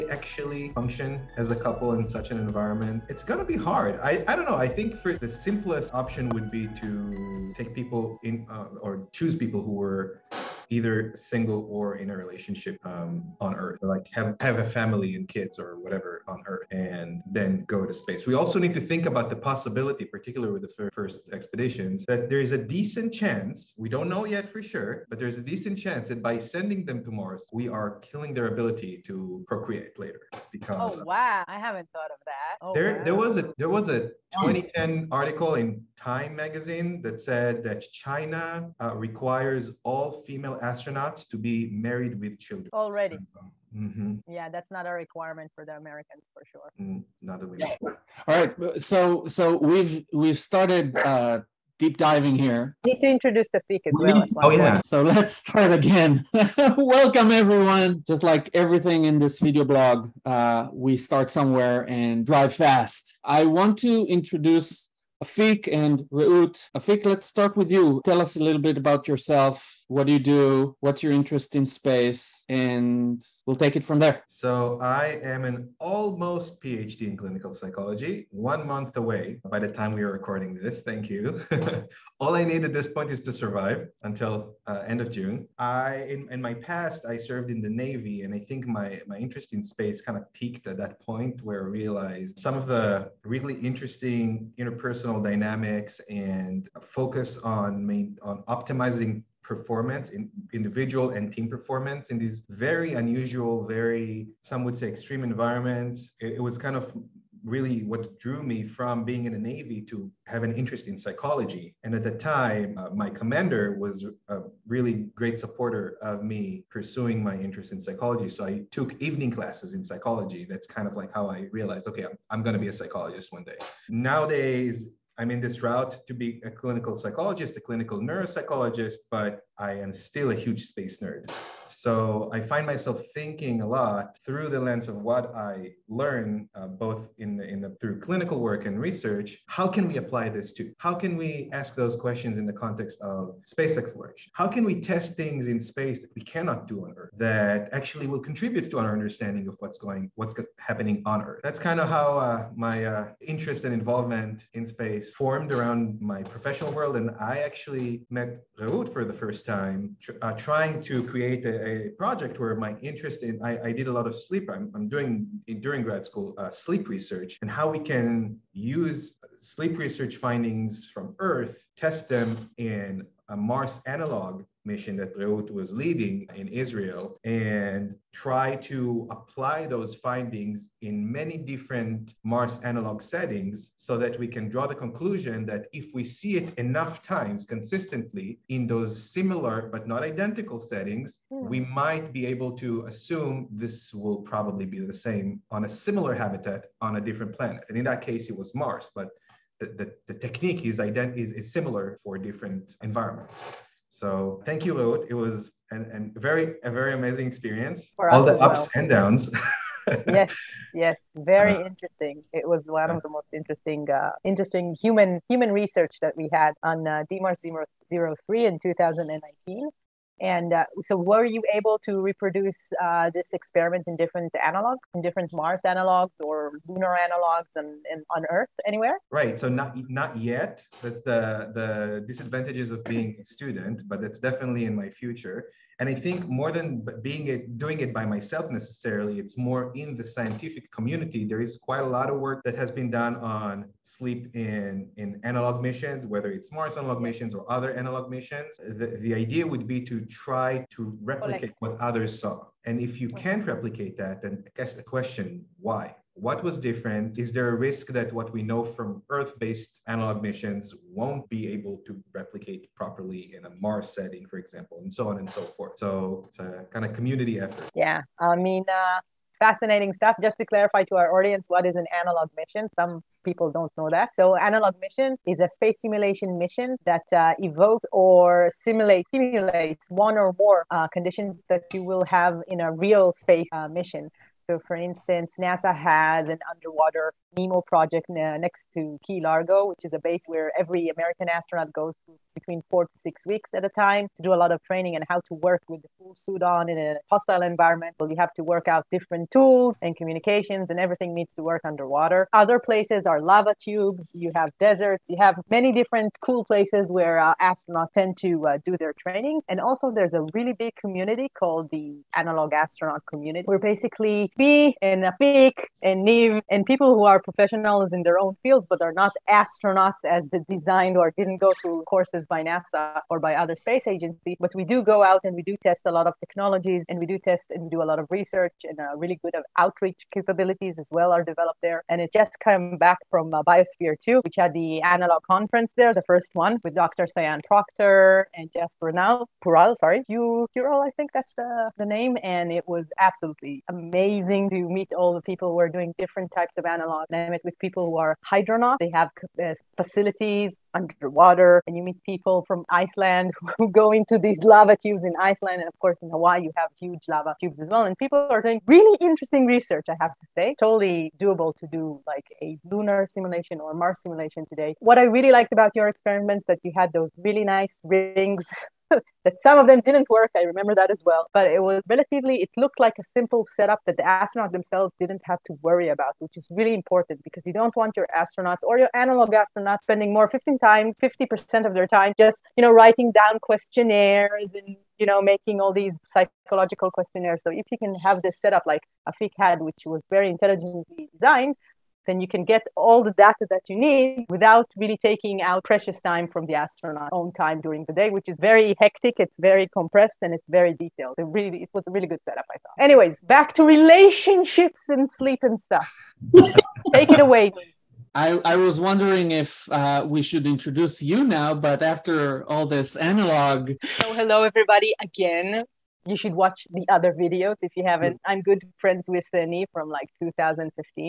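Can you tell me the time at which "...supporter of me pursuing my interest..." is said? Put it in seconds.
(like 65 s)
115 s.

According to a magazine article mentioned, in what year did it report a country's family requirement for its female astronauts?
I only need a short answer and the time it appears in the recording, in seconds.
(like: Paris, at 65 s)
2010, at 34 s.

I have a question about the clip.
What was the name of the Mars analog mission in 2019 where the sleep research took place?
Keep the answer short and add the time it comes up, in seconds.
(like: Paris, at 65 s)
DMARS 03, at 217 s.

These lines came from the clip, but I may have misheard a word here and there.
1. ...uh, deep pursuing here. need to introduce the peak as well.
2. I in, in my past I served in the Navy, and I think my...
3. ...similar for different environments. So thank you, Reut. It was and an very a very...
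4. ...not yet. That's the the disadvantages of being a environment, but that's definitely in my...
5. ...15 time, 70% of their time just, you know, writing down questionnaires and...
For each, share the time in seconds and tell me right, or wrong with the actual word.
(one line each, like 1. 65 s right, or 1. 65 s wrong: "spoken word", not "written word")
1. 50 s wrong: "diving", not "pursuing"
2. 85 s right
3. 201 s right
4. 229 s wrong: "student", not "environment"
5. 380 s wrong: "50", not "70".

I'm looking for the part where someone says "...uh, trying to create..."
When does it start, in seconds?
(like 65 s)
160 s.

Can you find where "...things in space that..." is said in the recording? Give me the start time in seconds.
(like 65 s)
145 s.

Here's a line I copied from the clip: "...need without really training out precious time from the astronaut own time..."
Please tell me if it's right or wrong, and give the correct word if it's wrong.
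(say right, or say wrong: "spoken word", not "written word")
wrong: "taking", not "training".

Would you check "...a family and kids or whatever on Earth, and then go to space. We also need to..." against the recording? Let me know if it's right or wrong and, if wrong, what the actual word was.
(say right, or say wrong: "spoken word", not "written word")
right.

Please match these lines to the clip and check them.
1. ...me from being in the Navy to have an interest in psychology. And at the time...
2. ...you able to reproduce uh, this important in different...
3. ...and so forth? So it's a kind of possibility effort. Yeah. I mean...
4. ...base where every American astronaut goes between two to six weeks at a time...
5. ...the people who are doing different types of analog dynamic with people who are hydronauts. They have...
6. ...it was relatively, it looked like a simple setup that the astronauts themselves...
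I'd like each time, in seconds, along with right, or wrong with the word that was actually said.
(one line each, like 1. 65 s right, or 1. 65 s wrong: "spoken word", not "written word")
1. 108 s right
2. 221 s wrong: "experiment", not "important"
3. 265 s wrong: "community", not "possibility"
4. 289 s wrong: "four", not "two"
5. 345 s right
6. 371 s right.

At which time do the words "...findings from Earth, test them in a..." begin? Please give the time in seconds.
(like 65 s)
170 s.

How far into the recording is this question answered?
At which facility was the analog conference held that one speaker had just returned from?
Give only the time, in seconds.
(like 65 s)
333 s.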